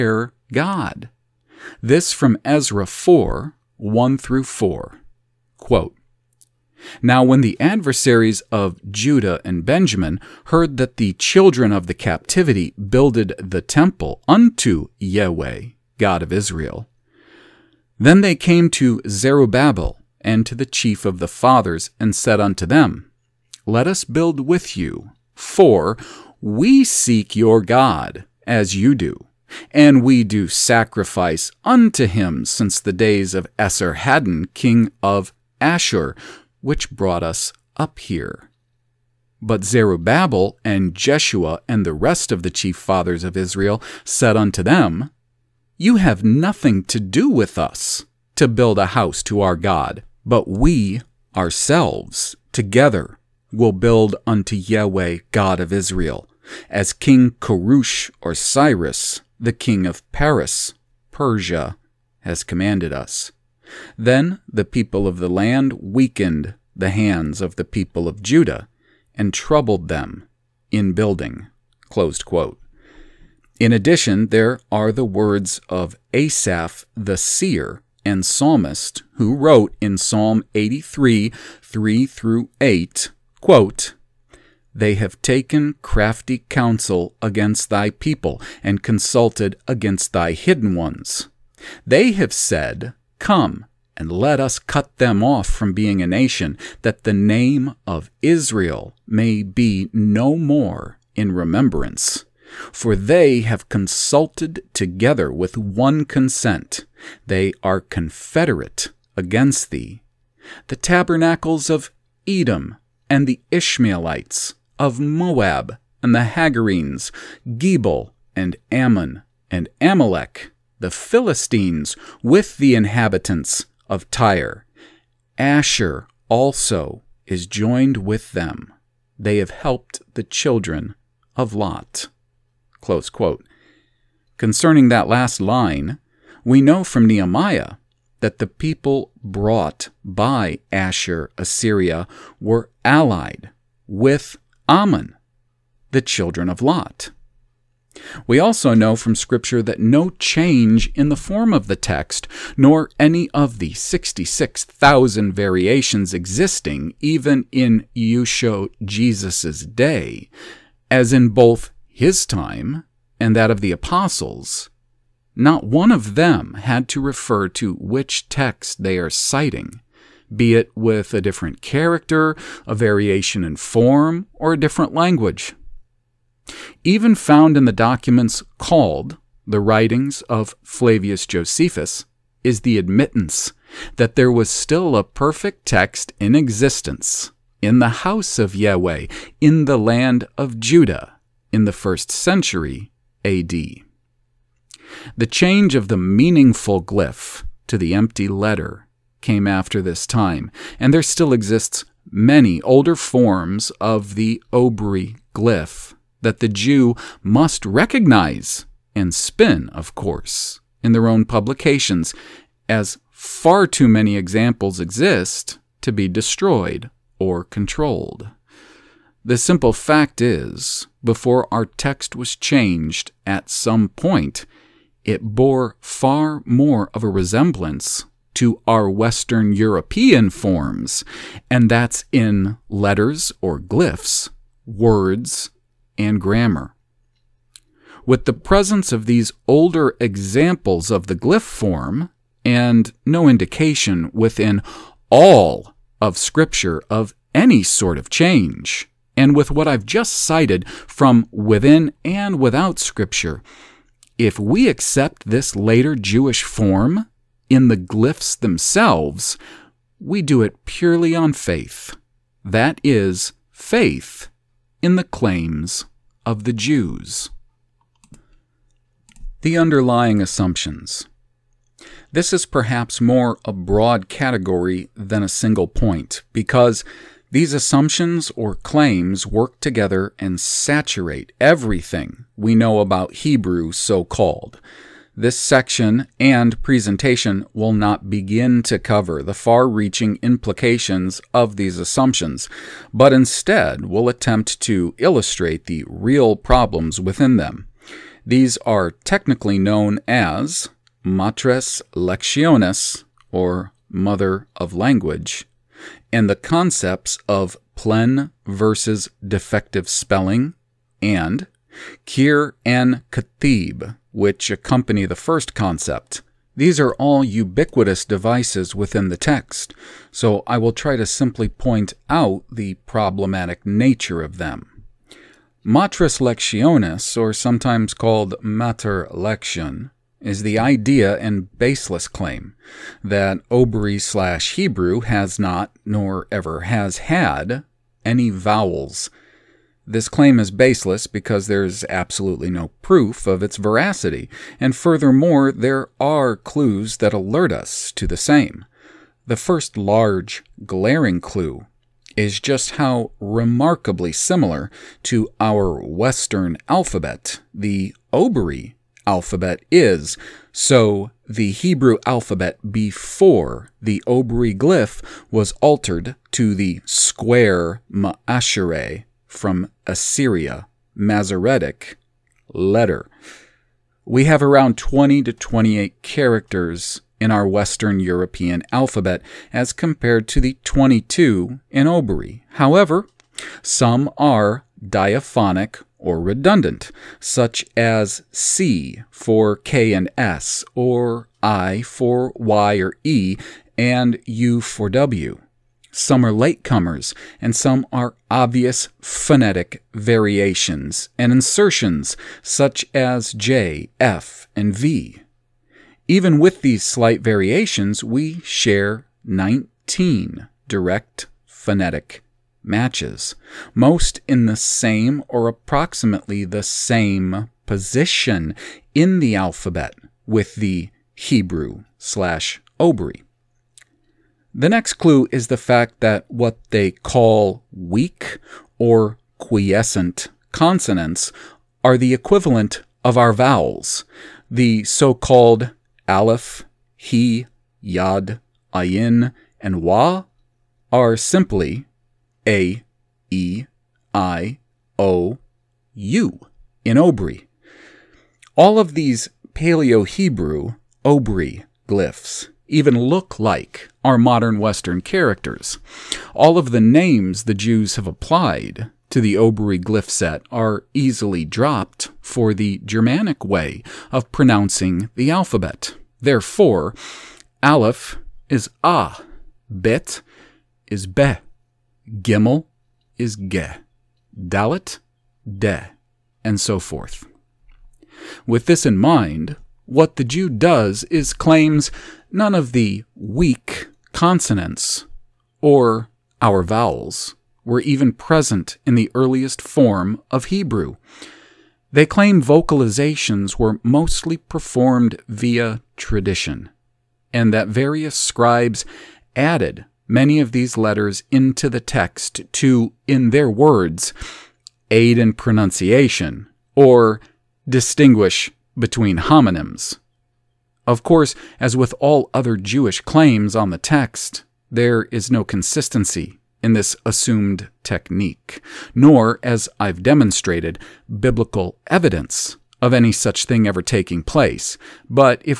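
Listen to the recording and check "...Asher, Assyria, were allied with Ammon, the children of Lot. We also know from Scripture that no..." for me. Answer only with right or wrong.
right.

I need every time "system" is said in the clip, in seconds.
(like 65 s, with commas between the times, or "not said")
not said.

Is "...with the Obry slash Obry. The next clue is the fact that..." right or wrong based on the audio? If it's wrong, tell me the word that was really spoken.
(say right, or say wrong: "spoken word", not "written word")
wrong: "Hebrew", not "Obry".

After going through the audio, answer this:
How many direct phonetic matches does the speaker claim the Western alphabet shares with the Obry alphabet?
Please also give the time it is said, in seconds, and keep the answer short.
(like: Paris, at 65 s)
19, at 409 s.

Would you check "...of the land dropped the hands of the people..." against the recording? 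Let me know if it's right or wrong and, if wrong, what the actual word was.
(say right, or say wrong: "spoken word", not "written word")
wrong: "weakened", not "dropped".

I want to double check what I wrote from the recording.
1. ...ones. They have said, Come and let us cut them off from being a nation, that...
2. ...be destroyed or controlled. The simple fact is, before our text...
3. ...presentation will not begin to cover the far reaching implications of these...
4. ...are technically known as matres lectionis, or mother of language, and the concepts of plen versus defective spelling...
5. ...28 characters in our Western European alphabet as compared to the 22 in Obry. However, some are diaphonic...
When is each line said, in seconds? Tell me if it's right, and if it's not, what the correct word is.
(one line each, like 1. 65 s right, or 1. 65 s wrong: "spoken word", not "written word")
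1. 90 s right
2. 215 s right
3. 286 s right
4. 298 s right
5. 375 s right.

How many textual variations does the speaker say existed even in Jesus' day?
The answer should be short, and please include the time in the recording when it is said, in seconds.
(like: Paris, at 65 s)
66,000, at 153 s.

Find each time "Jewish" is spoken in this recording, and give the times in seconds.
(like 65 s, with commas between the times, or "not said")
255 s, 512 s.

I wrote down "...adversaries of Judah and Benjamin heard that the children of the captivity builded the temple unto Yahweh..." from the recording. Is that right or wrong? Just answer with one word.
right.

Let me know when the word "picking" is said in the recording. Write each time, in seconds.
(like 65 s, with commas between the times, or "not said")
not said.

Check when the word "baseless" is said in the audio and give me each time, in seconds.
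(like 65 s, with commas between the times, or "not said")
331 s, 340 s.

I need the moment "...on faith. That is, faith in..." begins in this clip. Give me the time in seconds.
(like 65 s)
261 s.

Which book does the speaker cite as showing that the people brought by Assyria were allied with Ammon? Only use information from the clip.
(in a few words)
Nehemiah.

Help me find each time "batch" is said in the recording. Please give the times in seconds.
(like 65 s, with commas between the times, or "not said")
not said.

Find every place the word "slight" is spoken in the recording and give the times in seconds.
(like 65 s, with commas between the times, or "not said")
406 s.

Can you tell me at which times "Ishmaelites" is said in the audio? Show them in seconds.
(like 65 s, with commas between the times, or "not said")
113 s.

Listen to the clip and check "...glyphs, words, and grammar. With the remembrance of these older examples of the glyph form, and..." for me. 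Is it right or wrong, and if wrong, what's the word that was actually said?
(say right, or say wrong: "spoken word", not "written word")
wrong: "presence", not "remembrance".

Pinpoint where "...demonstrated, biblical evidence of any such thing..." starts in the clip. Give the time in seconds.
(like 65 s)
520 s.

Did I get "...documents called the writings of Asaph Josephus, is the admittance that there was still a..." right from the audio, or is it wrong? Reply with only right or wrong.
wrong.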